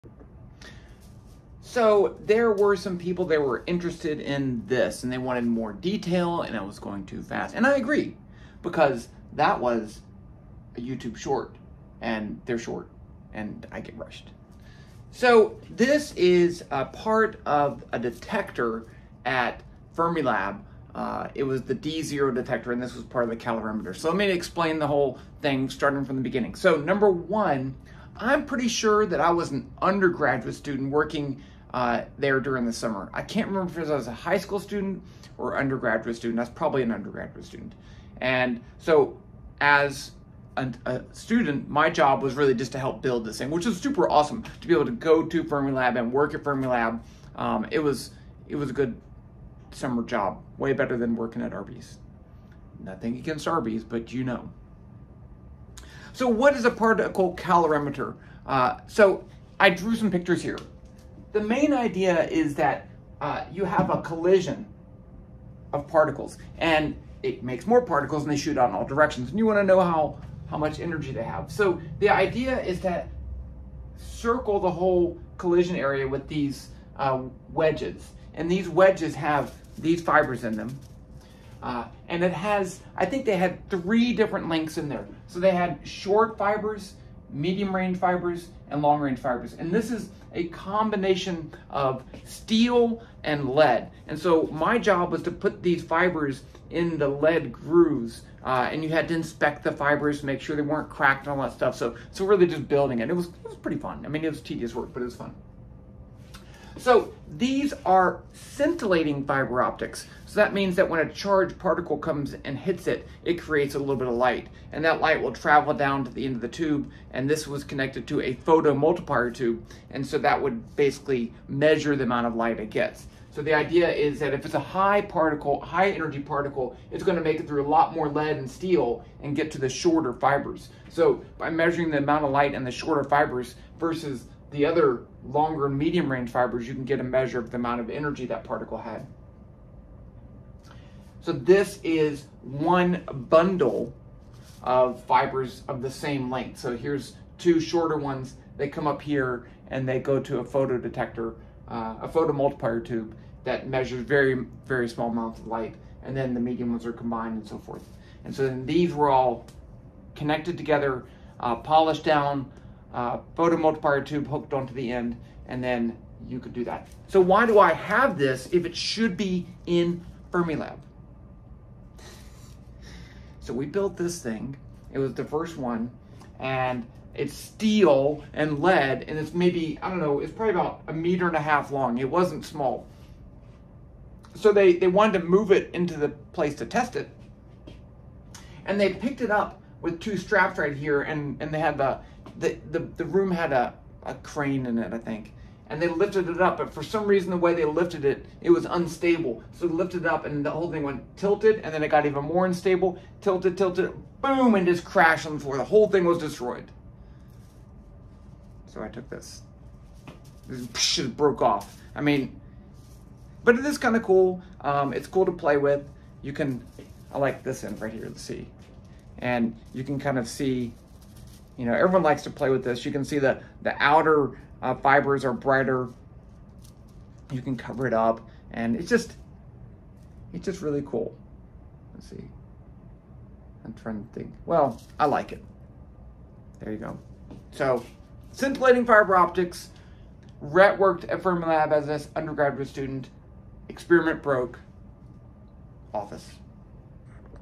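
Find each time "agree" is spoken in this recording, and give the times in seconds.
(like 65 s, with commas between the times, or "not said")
7 s.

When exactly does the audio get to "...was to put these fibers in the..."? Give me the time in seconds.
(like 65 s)
95 s.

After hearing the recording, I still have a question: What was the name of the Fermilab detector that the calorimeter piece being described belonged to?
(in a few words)
D0.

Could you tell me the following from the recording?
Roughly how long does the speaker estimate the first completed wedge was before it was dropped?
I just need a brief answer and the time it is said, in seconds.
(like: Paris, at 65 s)
About 1.5 meters, at 180 s.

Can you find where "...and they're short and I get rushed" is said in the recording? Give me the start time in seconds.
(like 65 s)
12 s.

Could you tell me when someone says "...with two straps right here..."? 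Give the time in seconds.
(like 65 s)
189 s.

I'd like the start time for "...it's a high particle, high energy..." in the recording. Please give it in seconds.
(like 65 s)
124 s.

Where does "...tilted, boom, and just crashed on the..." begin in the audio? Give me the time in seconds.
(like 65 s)
203 s.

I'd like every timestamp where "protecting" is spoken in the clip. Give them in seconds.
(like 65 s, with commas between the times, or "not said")
not said.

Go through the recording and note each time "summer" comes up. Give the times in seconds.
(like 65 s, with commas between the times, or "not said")
32 s, 49 s.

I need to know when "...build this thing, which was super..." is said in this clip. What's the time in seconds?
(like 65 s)
43 s.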